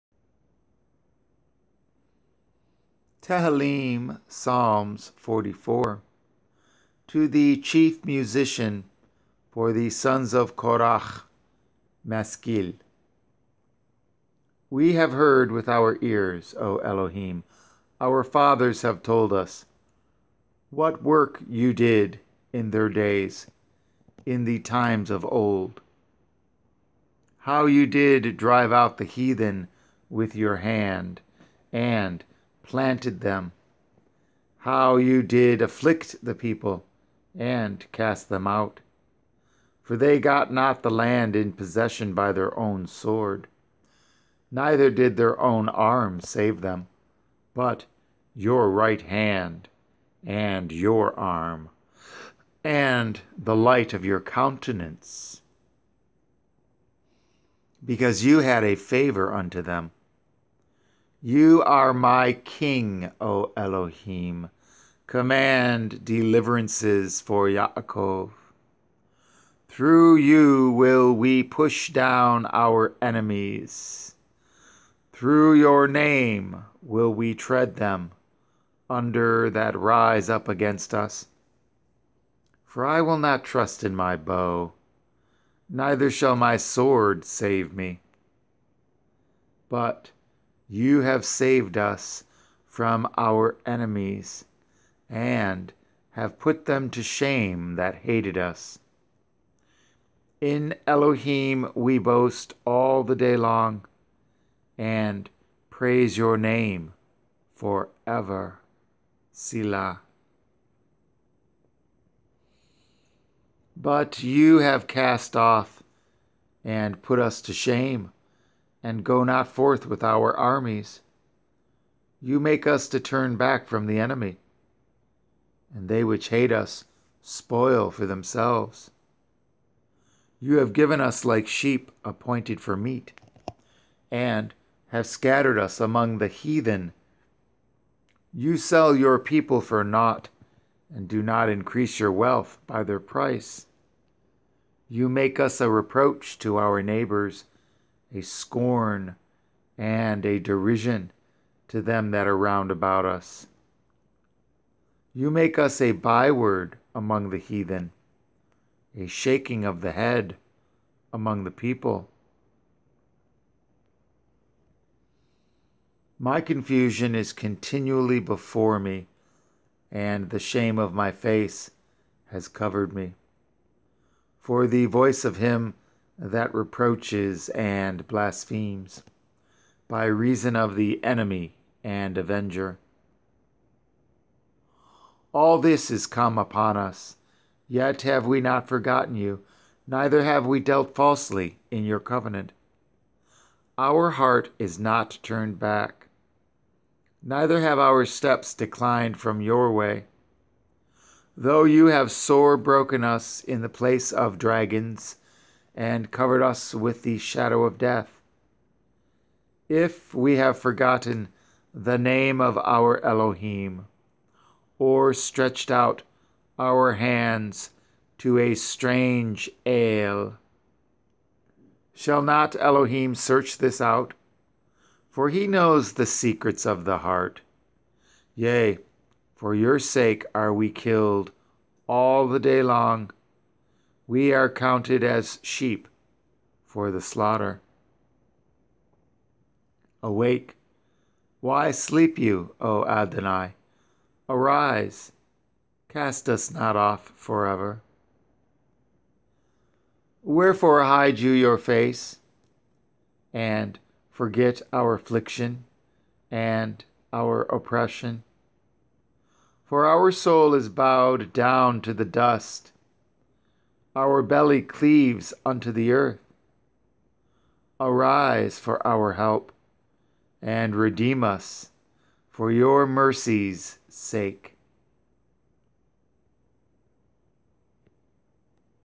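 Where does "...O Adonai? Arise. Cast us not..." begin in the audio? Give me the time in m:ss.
4:02.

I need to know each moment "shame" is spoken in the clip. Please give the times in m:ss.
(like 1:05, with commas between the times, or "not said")
1:37, 1:57, 2:50.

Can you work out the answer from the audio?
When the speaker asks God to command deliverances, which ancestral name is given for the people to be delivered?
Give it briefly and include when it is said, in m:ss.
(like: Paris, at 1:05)
Yaakov, at 1:07.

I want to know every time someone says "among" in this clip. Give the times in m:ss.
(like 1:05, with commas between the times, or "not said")
2:15, 2:36, 2:41.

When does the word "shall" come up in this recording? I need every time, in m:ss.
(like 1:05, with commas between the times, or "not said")
1:26, 3:41.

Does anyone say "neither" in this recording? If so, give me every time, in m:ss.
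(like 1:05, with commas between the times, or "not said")
0:44, 1:25, 3:09, 3:17.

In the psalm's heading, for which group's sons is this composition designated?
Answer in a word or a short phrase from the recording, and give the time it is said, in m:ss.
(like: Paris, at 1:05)
Korach, at 0:10.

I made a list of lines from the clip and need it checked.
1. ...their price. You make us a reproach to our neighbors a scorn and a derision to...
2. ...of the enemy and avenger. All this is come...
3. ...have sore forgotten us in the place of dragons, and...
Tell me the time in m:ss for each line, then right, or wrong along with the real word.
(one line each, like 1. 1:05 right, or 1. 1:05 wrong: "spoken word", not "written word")
1. 2:22 right
2. 3:00 right
3. 3:21 wrong: "broken", not "forgotten".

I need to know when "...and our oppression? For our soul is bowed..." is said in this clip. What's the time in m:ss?
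4:16.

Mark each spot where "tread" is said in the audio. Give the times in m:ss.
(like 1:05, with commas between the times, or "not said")
1:17.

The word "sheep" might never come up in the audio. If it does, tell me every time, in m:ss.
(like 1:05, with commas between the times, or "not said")
2:11, 3:55.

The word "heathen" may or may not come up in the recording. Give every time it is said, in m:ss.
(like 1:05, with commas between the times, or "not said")
0:29, 2:16, 2:37.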